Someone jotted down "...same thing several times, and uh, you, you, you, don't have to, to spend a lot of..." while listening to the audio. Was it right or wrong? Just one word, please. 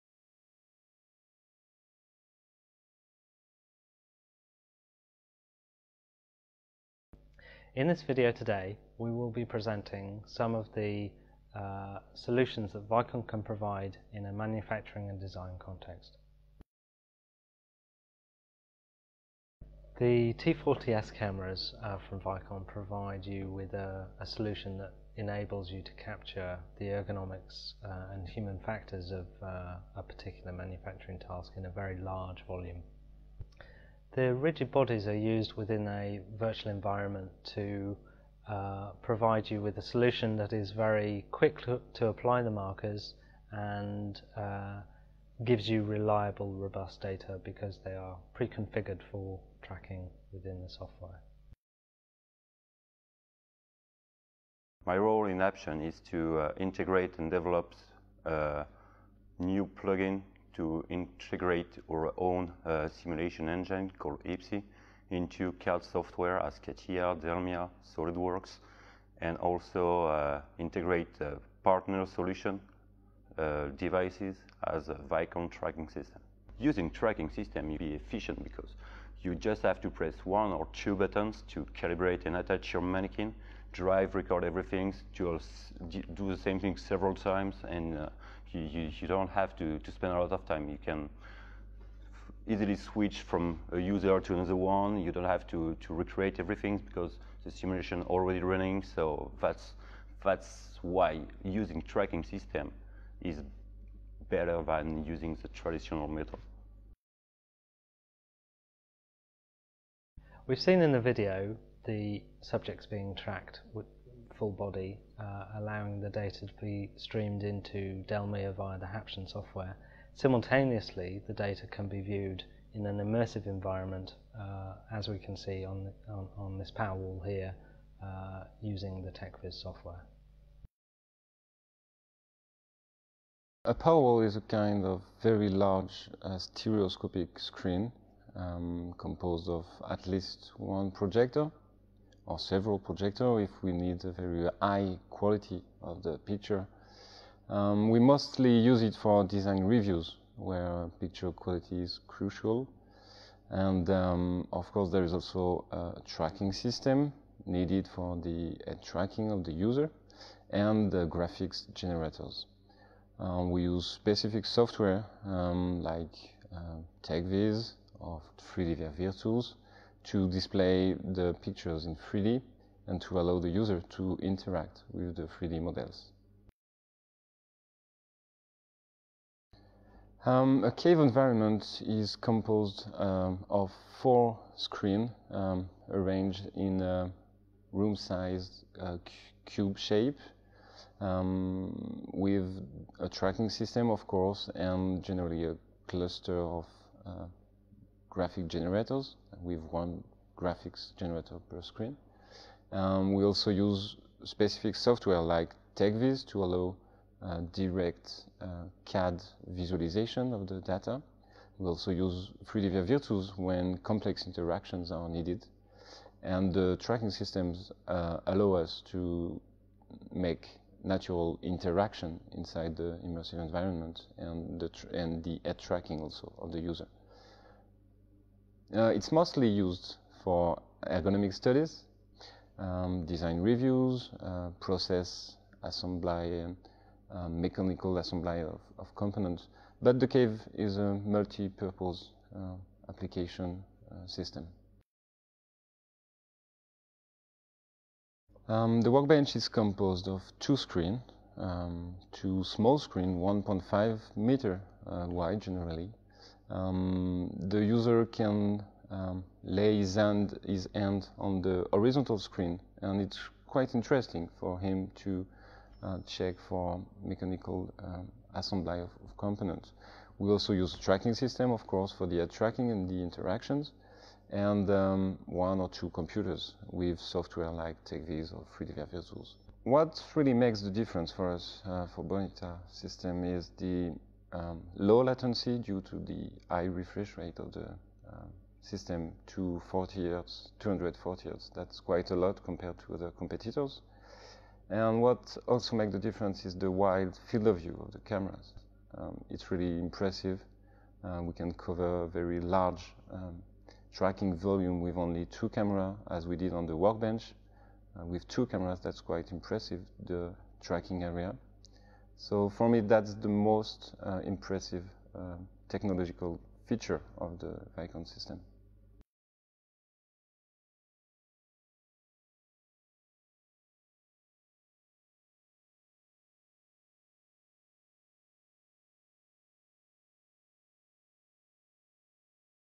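right.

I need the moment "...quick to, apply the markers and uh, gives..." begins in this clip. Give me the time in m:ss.
0:41.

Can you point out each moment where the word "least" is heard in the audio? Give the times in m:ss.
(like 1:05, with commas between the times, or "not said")
2:20.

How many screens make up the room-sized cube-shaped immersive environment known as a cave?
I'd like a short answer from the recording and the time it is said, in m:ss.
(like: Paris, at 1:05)
4, at 3:04.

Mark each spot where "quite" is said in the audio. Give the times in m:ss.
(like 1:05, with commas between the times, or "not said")
4:23, 4:51, 5:09.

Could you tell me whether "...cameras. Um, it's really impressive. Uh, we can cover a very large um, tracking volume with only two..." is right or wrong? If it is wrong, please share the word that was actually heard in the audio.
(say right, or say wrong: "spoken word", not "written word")
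right.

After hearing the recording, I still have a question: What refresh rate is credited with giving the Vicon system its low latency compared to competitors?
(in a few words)
240 hertz.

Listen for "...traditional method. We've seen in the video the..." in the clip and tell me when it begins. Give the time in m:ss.
1:45.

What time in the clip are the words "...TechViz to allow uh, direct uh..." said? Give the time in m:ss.
3:25.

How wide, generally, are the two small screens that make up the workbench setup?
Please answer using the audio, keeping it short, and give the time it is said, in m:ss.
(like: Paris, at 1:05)
1.5 meters, at 4:13.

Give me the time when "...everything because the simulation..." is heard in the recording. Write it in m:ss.
1:36.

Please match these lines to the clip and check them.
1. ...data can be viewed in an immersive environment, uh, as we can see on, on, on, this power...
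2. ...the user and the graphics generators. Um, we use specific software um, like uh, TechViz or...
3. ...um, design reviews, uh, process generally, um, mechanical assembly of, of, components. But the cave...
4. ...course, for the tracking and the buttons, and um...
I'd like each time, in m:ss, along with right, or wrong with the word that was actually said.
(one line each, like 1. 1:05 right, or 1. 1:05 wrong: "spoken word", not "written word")
1. 2:01 right
2. 2:39 right
3. 3:52 wrong: "assembly", not "generally"
4. 4:31 wrong: "interactions", not "buttons".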